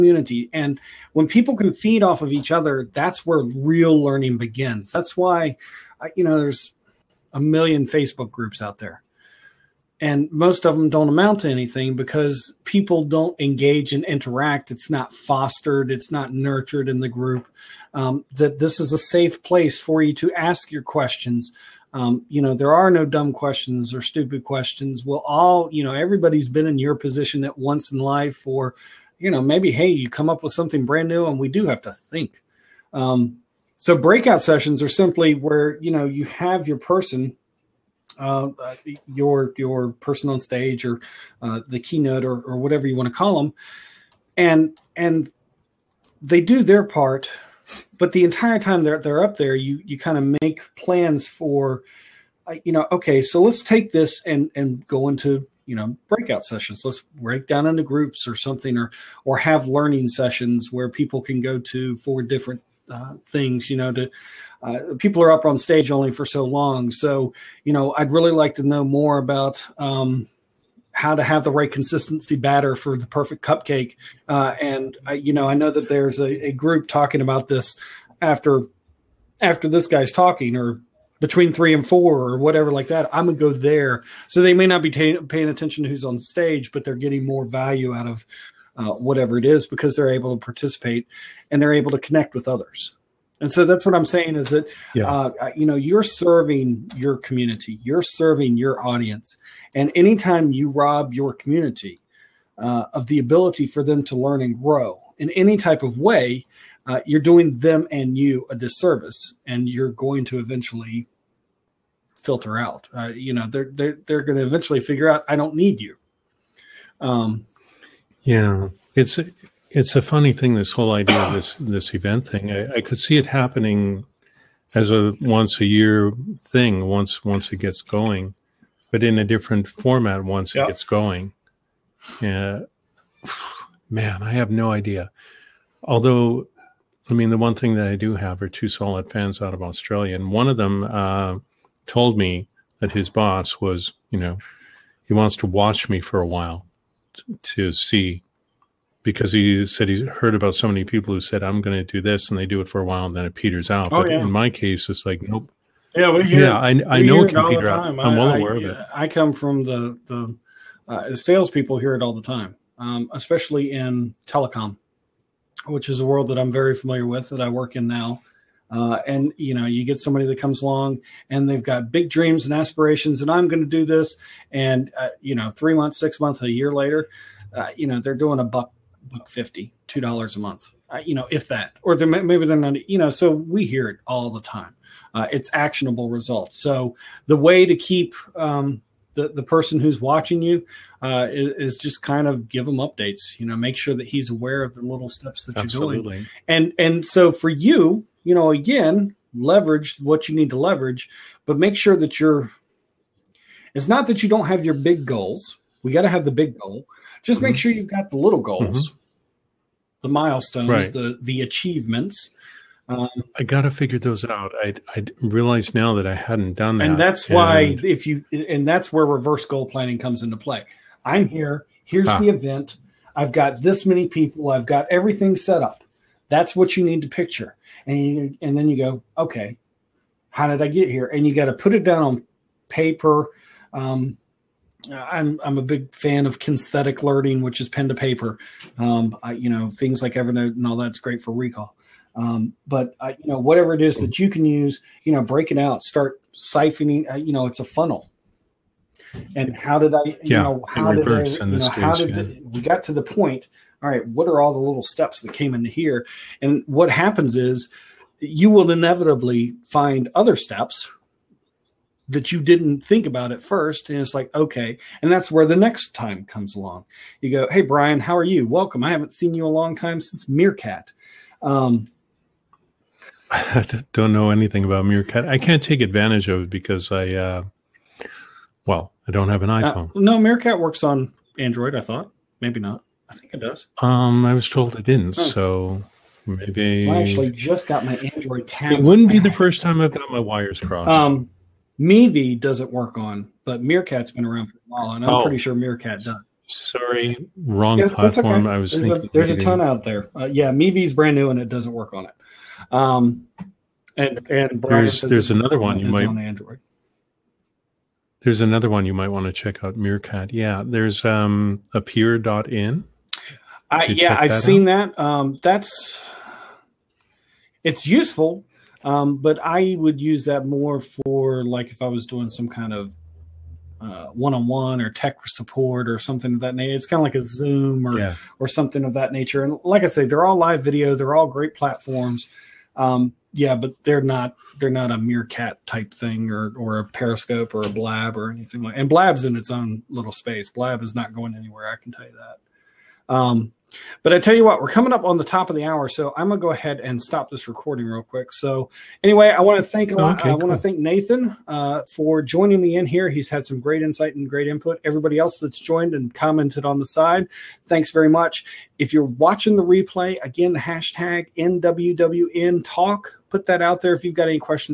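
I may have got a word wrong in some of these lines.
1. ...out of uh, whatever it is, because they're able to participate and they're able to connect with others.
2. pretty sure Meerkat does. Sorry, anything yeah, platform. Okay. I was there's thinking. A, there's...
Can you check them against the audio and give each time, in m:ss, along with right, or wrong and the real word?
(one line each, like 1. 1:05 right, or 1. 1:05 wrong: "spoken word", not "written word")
1. 1:27 right
2. 4:55 wrong: "wrong", not "anything".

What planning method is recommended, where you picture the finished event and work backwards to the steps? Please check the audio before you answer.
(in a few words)
Reverse goal planning.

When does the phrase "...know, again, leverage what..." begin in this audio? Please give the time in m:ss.
3:18.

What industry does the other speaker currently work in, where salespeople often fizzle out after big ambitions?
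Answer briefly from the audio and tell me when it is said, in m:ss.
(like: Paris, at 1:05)
Telecom, at 2:44.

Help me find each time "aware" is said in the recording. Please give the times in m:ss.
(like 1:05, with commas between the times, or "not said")
2:38, 3:14.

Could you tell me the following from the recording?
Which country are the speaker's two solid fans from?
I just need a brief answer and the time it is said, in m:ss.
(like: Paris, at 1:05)
Australia, at 2:19.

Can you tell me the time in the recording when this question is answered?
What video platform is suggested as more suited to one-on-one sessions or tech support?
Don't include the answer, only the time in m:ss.
5:11.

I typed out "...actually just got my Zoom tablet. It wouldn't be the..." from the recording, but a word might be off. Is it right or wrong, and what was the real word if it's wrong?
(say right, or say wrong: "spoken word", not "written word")
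wrong: "Android", not "Zoom".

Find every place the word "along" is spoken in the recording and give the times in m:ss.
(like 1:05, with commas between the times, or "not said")
2:50, 4:26.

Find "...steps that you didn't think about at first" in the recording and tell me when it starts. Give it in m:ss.
4:20.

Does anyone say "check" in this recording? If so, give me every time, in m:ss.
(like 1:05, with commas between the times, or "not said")
5:09.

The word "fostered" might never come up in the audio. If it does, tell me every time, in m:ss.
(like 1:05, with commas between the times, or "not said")
0:15.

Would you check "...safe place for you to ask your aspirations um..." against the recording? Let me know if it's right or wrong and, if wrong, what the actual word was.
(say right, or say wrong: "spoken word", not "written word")
wrong: "questions", not "aspirations".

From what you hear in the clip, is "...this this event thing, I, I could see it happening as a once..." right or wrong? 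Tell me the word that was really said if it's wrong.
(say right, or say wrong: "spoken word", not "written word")
right.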